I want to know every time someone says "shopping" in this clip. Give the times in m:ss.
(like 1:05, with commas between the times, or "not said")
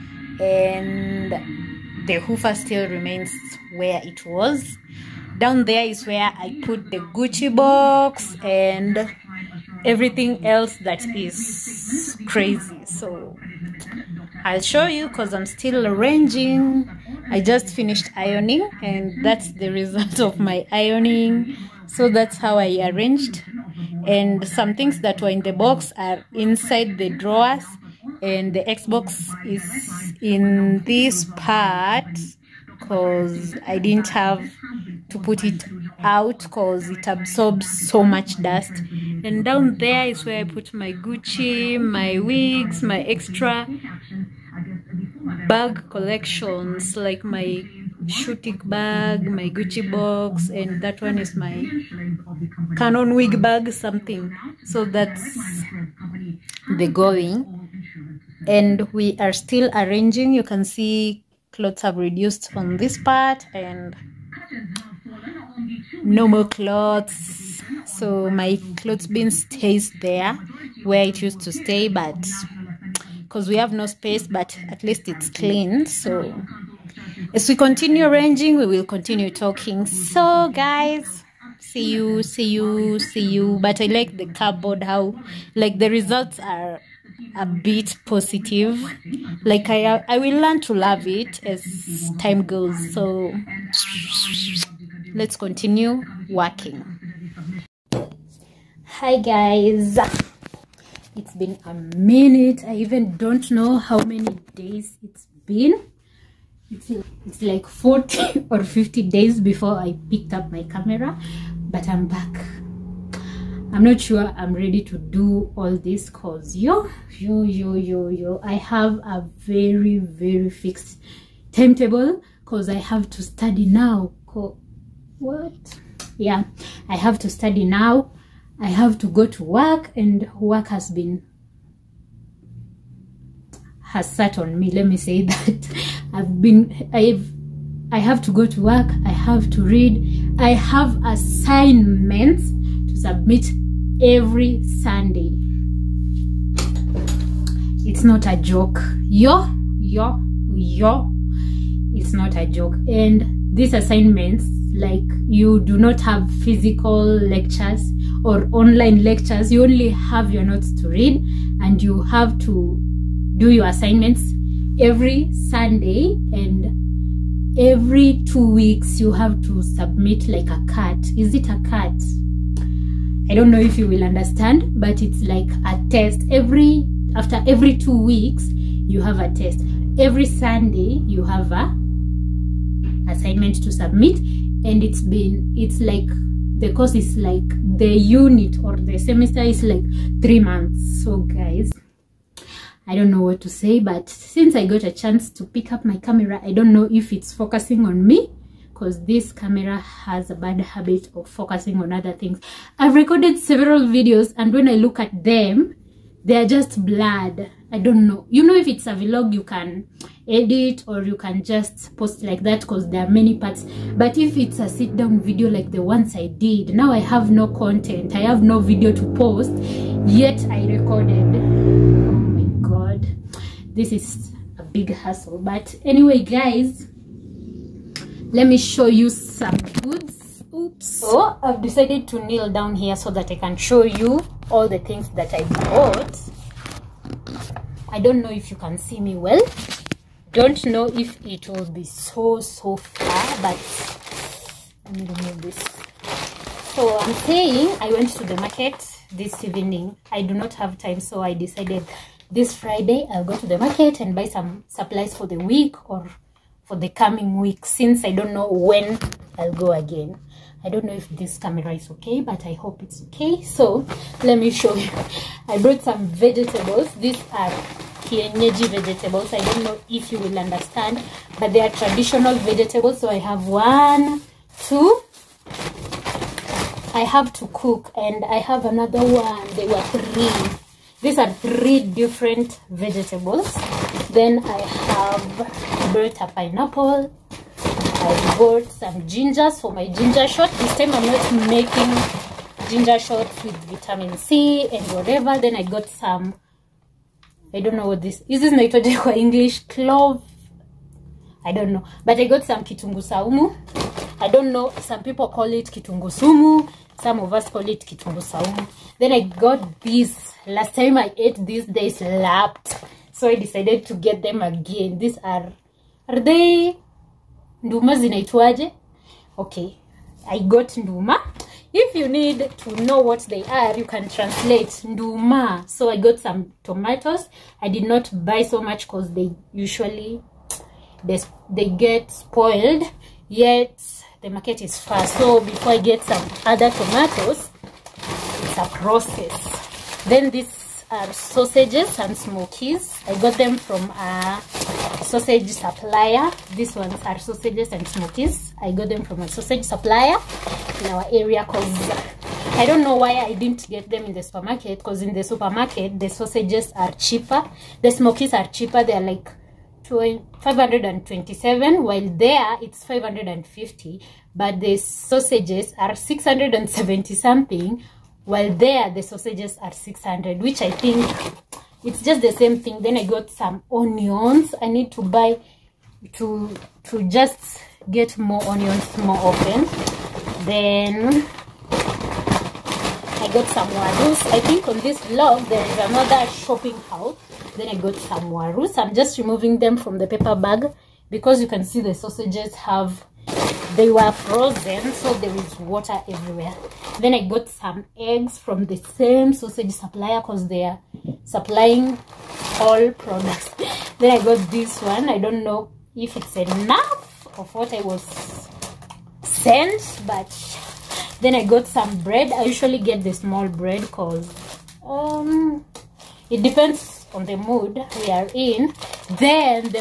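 6:26.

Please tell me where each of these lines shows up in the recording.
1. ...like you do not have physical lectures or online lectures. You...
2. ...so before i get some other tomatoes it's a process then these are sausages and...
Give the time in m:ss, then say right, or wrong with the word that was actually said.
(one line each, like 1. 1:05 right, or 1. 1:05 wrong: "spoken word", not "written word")
1. 2:34 right
2. 5:35 right.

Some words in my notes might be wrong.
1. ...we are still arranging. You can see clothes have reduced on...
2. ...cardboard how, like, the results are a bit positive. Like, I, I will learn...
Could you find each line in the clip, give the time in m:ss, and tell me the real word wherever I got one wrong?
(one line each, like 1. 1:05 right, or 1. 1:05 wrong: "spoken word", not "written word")
1. 0:58 right
2. 1:24 right.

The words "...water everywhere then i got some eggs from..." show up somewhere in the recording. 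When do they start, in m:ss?
6:35.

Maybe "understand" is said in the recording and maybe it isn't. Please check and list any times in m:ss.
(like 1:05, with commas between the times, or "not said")
2:54, 4:30.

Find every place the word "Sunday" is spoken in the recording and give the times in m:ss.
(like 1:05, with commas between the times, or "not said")
2:24, 2:45, 3:00.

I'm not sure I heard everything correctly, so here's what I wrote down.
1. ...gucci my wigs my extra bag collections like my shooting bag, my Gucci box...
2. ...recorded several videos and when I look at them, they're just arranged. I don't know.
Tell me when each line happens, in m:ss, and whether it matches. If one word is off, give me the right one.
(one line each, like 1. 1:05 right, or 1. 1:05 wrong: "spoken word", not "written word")
1. 0:40 right
2. 3:22 wrong: "blurred", not "arranged".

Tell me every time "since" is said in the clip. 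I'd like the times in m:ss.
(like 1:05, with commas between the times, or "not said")
3:14, 4:17.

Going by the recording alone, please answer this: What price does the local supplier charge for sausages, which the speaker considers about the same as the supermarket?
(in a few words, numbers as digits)
600.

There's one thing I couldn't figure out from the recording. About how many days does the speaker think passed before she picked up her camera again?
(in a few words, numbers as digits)
40.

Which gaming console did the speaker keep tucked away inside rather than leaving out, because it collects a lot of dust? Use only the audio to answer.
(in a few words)
Xbox.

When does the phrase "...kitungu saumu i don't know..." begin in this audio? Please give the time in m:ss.
5:02.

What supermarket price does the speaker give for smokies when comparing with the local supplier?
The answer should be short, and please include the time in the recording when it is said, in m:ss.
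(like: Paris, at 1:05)
527, at 6:00.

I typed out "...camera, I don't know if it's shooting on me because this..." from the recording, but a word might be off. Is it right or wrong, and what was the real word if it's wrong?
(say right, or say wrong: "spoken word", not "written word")
wrong: "focusing", not "shooting".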